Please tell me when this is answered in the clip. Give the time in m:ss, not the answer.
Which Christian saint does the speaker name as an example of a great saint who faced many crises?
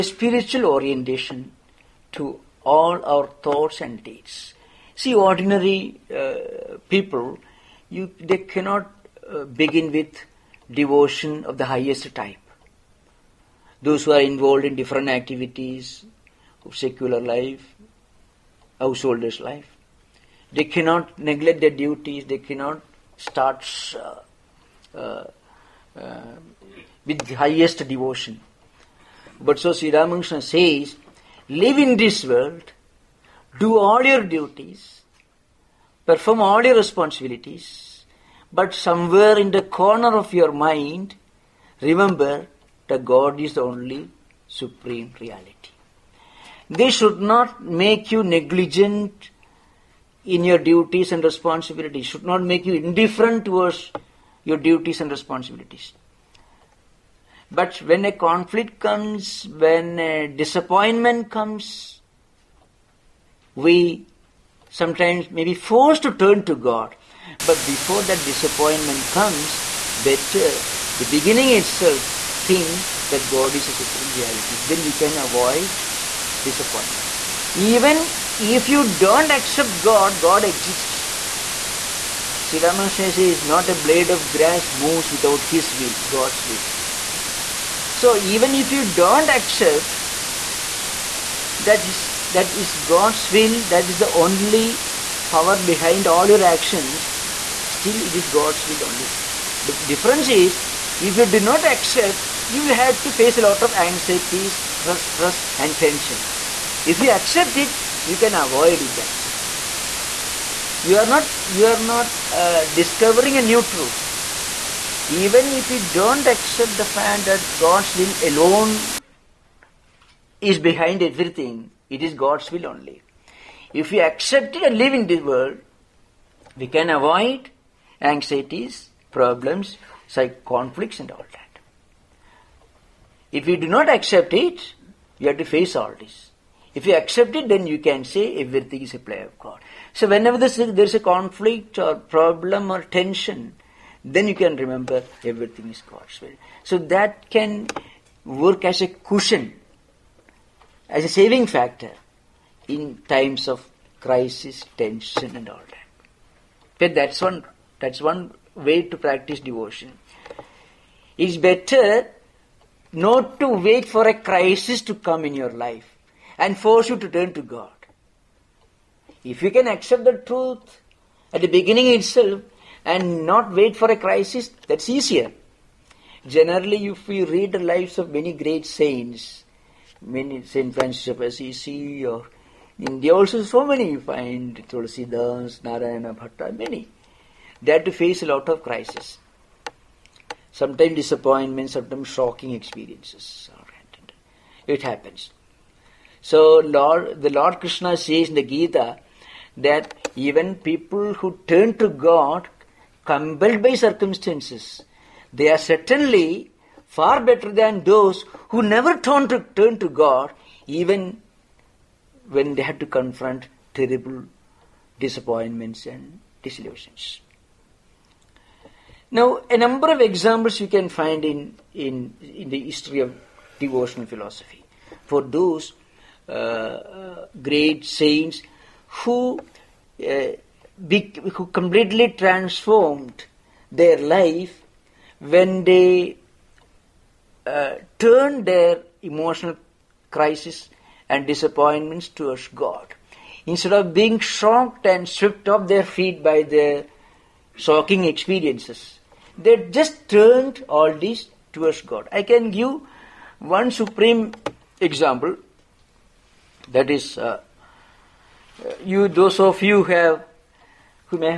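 3:00.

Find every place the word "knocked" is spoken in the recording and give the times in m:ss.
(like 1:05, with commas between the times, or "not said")
not said.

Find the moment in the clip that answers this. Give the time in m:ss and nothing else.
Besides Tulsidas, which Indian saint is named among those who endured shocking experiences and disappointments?
3:05.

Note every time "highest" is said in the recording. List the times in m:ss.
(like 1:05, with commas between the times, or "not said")
0:11, 0:27.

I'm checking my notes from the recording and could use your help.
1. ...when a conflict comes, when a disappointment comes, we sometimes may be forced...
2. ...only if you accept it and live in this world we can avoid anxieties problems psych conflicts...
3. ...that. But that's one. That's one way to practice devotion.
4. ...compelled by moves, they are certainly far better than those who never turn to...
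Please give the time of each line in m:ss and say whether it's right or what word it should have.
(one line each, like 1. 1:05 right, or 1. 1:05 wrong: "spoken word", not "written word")
1. 0:57 right
2. 2:02 right
3. 2:35 right
4. 3:23 wrong: "circumstances", not "moves".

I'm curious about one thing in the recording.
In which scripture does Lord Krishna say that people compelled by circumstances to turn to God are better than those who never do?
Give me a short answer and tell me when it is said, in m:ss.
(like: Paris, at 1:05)
the Gita, at 3:18.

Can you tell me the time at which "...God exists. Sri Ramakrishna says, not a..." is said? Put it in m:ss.
1:20.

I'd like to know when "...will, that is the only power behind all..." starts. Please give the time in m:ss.
1:33.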